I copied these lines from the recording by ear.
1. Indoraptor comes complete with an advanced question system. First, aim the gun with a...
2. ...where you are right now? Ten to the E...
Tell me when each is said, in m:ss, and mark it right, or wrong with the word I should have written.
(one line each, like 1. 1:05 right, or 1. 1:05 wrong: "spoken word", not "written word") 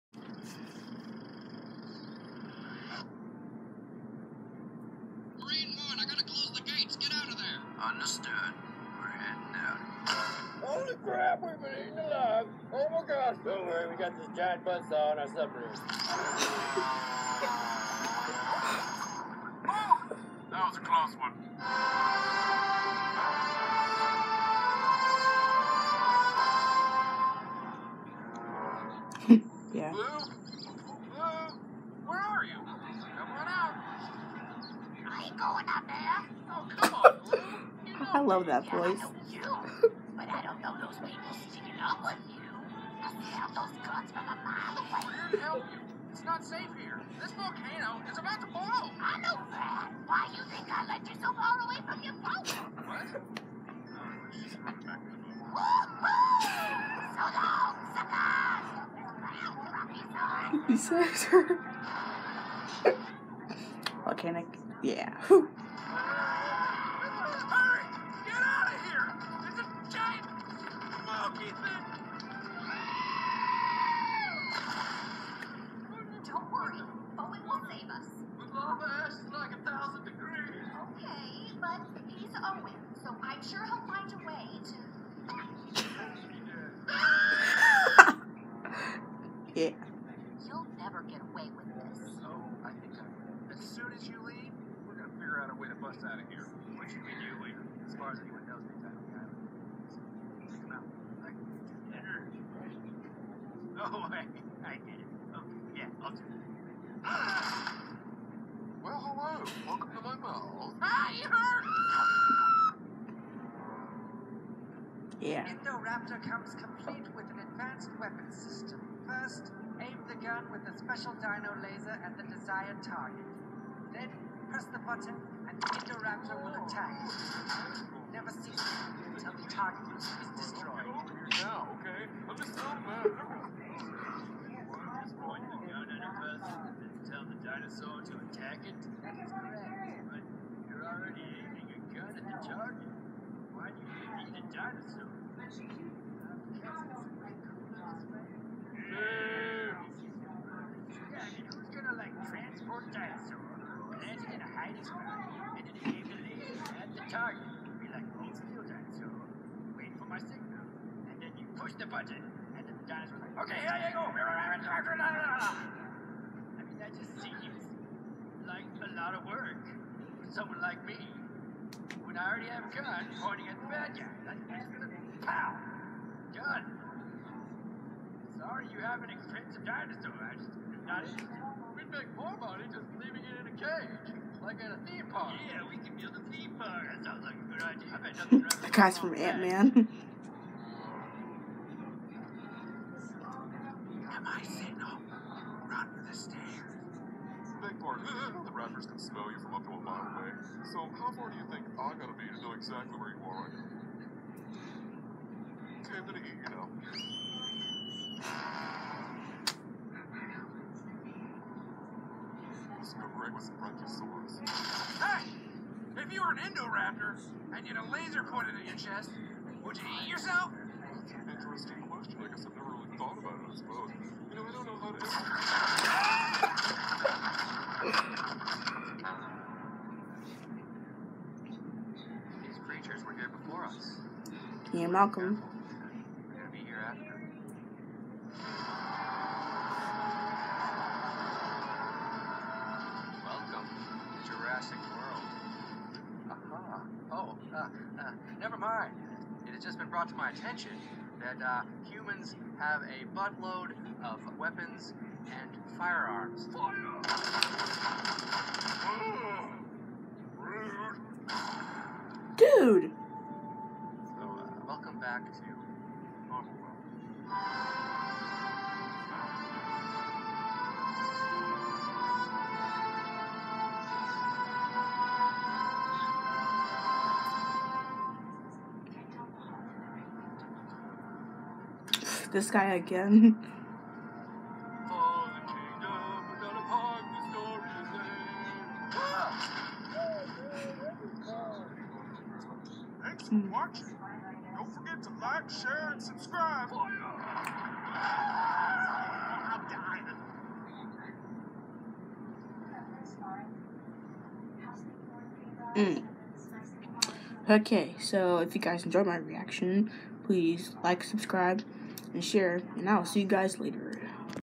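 1. 1:55 wrong: "weapon", not "question"
2. 3:22 right.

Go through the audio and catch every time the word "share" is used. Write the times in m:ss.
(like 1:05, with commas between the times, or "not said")
4:55, 5:12.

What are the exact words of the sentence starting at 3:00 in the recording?
I just not We'd make more money just leaving it in a cage, like at a theme park.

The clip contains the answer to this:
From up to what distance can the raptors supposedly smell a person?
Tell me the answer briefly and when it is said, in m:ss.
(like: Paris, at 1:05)
a mile, at 3:19.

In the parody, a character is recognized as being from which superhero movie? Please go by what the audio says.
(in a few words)
Ant Man.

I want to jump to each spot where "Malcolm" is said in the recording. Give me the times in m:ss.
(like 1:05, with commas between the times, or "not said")
3:54.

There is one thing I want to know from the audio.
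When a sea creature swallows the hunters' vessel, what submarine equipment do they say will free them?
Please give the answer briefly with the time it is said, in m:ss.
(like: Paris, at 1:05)
giant saw, at 0:14.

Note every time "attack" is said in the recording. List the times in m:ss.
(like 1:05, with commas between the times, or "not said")
2:06, 2:18.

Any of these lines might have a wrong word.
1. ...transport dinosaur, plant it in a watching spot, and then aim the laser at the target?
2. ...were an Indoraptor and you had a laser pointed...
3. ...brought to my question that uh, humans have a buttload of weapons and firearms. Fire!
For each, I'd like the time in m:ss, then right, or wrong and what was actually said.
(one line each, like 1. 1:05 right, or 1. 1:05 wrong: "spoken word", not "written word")
1. 2:32 wrong: "hiding", not "watching"
2. 3:36 right
3. 4:09 wrong: "attention", not "question".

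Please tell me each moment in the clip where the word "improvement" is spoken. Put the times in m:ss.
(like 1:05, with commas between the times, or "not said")
not said.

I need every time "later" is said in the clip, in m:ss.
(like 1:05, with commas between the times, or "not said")
1:37, 5:13.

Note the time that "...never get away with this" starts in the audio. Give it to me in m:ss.
1:30.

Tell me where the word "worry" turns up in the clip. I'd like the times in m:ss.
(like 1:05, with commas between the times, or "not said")
0:13, 1:16.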